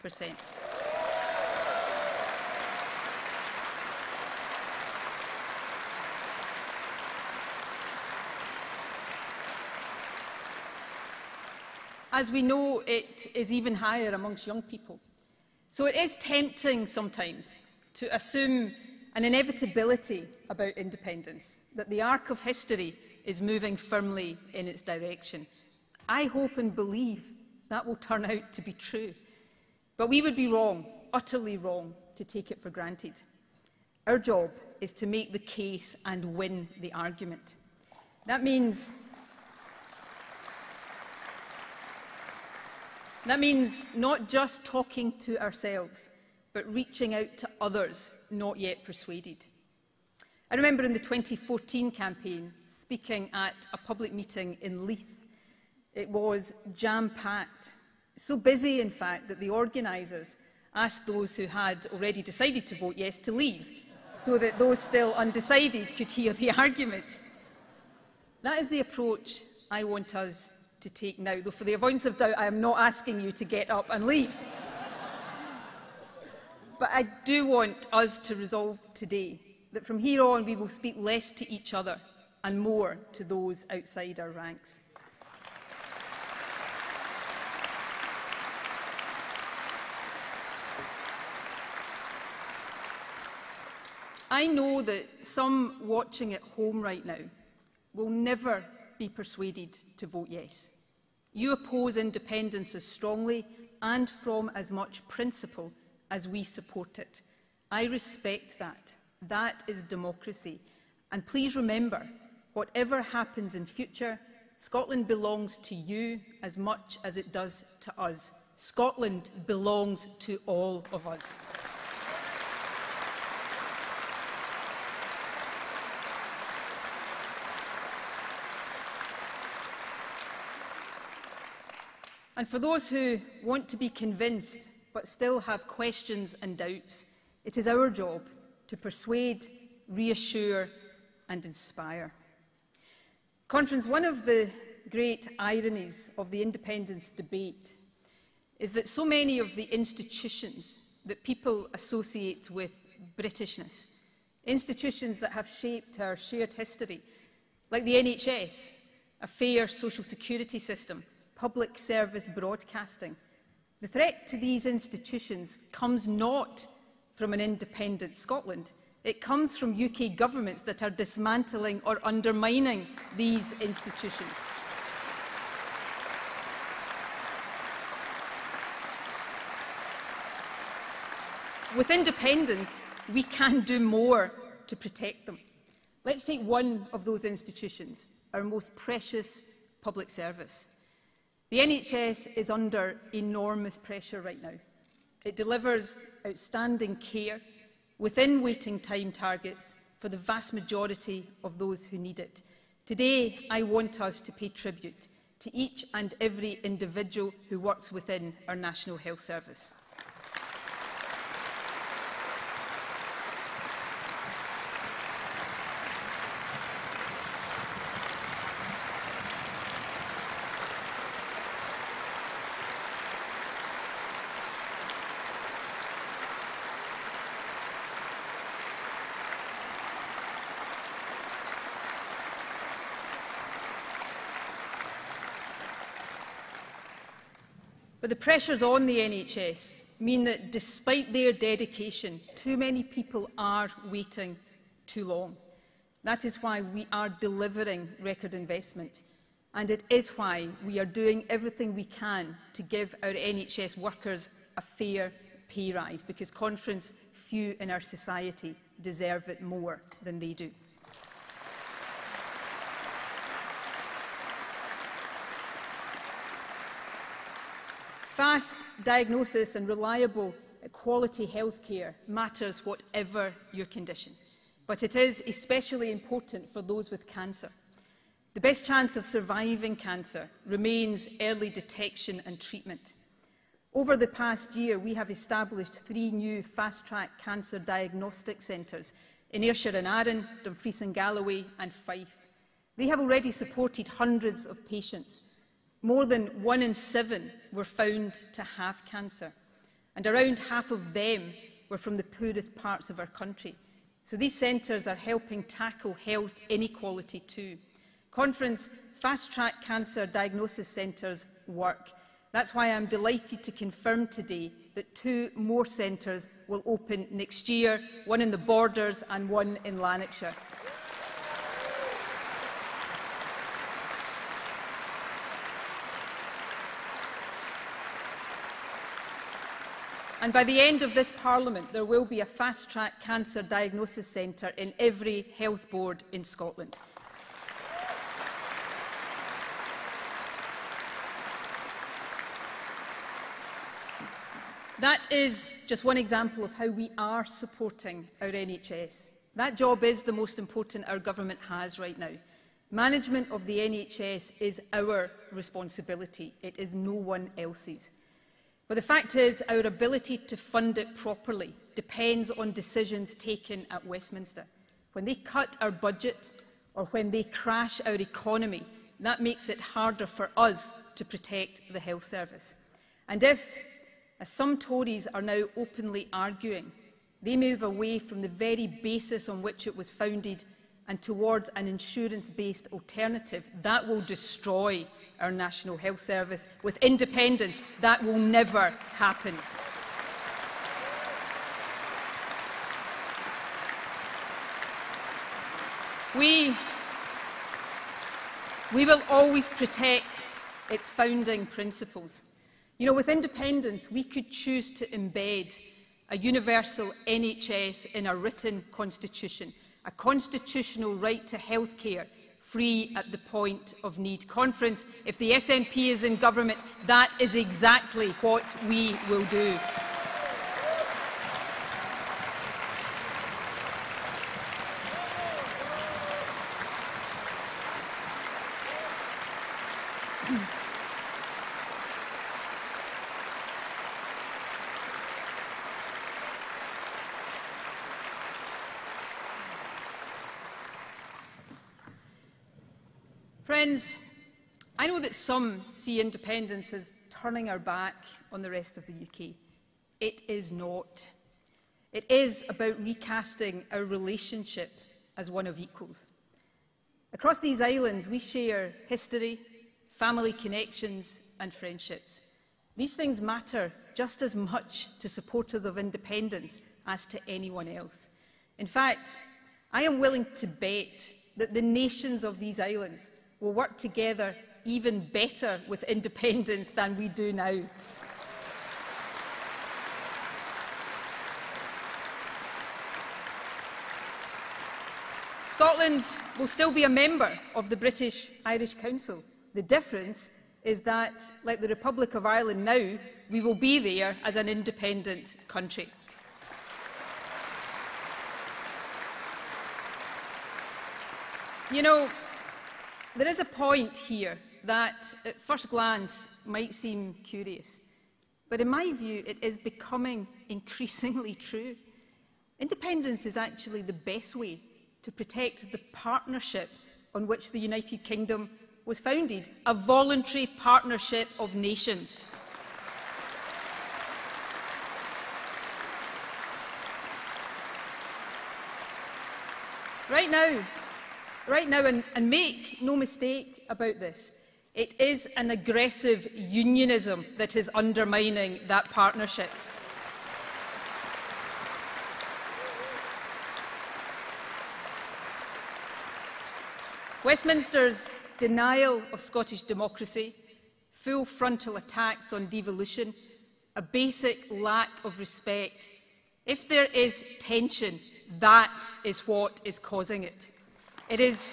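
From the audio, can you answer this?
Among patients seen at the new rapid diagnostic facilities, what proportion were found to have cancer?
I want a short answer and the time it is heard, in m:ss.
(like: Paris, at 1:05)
more than 1 in 7, at 4:55.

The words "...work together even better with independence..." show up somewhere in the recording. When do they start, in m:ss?
7:53.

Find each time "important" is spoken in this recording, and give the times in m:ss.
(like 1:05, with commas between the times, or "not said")
4:35, 5:50.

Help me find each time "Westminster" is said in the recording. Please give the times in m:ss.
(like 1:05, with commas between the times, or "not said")
6:03, 9:07.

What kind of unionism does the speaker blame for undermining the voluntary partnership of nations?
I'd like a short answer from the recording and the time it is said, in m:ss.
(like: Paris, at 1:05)
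aggressive, at 8:55.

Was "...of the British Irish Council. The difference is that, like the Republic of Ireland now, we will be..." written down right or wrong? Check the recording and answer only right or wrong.
right.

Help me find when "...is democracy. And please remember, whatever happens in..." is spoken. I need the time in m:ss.
1:49.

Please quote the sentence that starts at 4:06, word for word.
That is why we are delivering record investment.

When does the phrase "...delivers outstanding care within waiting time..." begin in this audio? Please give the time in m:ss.
3:15.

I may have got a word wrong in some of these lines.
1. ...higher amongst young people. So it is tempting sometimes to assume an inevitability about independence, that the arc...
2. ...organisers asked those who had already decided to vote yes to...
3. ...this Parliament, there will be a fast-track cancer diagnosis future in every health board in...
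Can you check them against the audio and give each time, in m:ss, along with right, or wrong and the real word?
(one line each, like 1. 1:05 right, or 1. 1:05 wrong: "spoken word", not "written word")
1. 0:13 right
2. 0:59 right
3. 5:30 wrong: "centre", not "future".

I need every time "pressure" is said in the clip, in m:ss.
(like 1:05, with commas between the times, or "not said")
3:13, 3:58.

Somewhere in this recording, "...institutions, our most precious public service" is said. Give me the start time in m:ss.
3:07.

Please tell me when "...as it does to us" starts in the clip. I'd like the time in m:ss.
1:57.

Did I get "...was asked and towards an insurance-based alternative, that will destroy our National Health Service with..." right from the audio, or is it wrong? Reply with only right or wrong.
wrong.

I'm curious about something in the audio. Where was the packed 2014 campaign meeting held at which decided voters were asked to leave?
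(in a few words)
Leith.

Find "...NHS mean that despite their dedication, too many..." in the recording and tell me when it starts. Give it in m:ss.
3:58.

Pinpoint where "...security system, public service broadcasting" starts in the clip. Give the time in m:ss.
2:40.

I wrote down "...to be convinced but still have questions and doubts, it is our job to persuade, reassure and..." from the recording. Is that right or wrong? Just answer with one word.
right.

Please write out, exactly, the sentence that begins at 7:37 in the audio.
Across these islands, we share history, family connections and friendships.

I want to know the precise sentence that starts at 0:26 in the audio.
I hope and believe that will turn out to be true.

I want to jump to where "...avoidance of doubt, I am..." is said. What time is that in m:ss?
1:11.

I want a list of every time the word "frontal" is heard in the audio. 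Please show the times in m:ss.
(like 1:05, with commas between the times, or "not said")
9:11.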